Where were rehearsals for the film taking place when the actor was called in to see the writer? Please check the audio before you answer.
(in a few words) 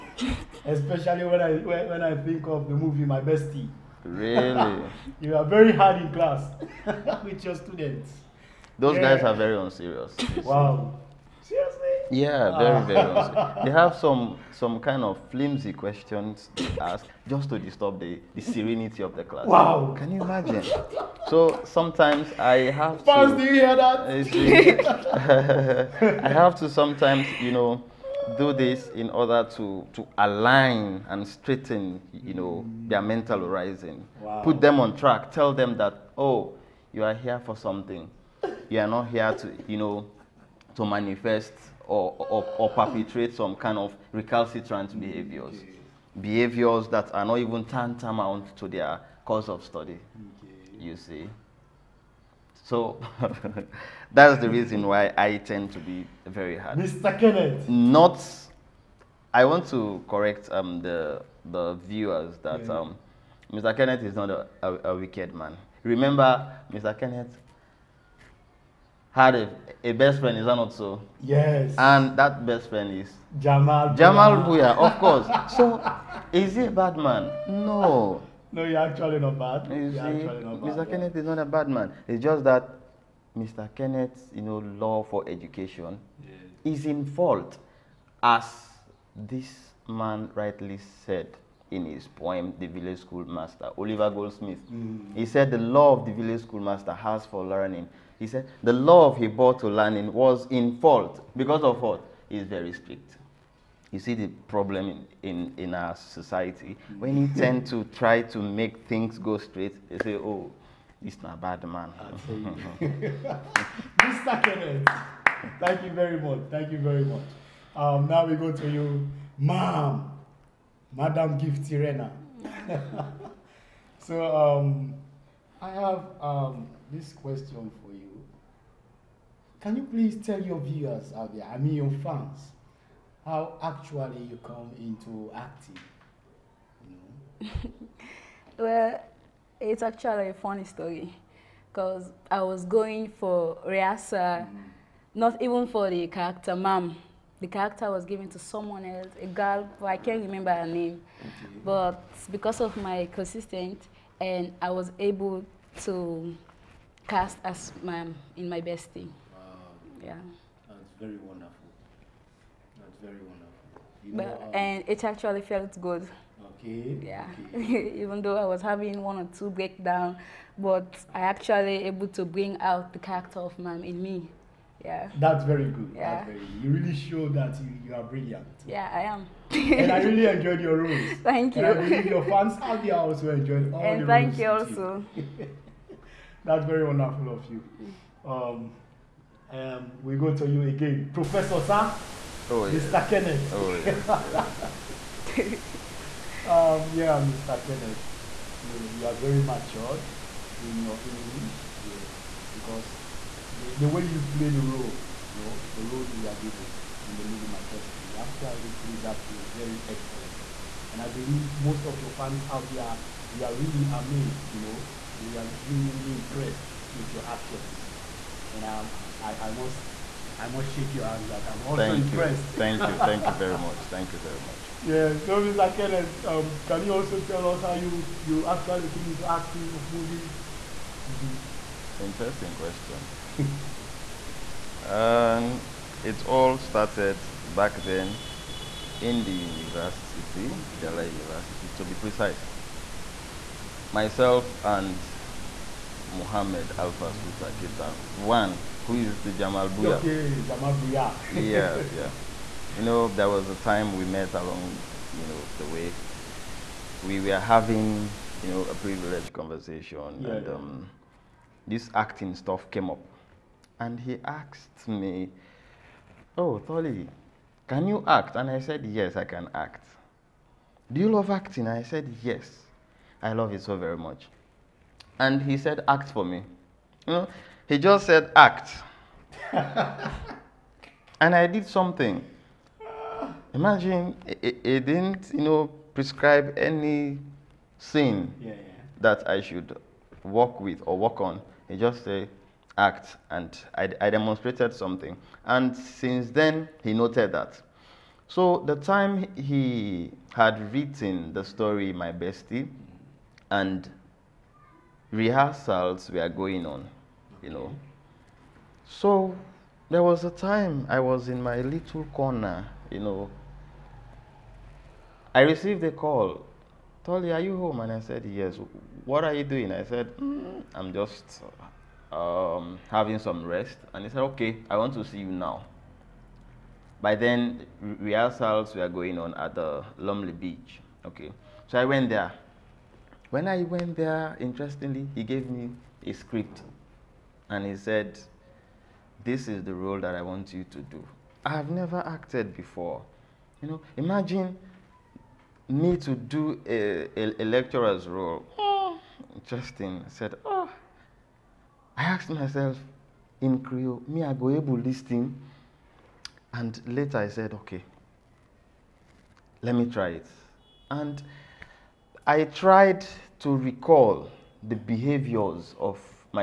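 Lumley Beach.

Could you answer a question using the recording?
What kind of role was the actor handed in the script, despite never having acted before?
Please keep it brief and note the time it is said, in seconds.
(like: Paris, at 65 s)
A lecturer, at 347 s.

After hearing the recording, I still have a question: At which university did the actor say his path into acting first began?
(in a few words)
Njala University.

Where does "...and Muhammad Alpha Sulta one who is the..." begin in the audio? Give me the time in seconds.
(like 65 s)
244 s.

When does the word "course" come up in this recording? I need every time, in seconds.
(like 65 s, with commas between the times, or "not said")
49 s, 75 s.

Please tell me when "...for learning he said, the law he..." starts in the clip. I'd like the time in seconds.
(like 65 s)
97 s.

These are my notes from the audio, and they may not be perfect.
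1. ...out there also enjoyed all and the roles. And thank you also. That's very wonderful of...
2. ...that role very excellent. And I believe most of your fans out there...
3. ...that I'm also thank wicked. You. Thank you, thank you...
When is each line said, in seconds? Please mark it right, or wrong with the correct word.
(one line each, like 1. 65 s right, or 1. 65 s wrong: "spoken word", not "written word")
1. 182 s right
2. 209 s right
3. 221 s wrong: "impressed", not "wicked".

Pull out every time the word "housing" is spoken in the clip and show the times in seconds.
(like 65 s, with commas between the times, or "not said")
not said.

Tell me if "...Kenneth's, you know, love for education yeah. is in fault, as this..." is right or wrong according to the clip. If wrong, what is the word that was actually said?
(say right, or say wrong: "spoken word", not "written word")
right.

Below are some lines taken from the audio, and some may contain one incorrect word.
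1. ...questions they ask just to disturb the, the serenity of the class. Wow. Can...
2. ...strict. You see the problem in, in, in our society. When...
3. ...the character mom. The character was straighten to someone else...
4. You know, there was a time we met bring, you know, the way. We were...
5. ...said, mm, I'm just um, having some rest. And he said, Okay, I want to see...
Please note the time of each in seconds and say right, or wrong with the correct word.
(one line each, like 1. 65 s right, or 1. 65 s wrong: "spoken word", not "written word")
1. 15 s right
2. 102 s right
3. 145 s wrong: "given", not "straighten"
4. 252 s wrong: "along", not "bring"
5. 319 s right.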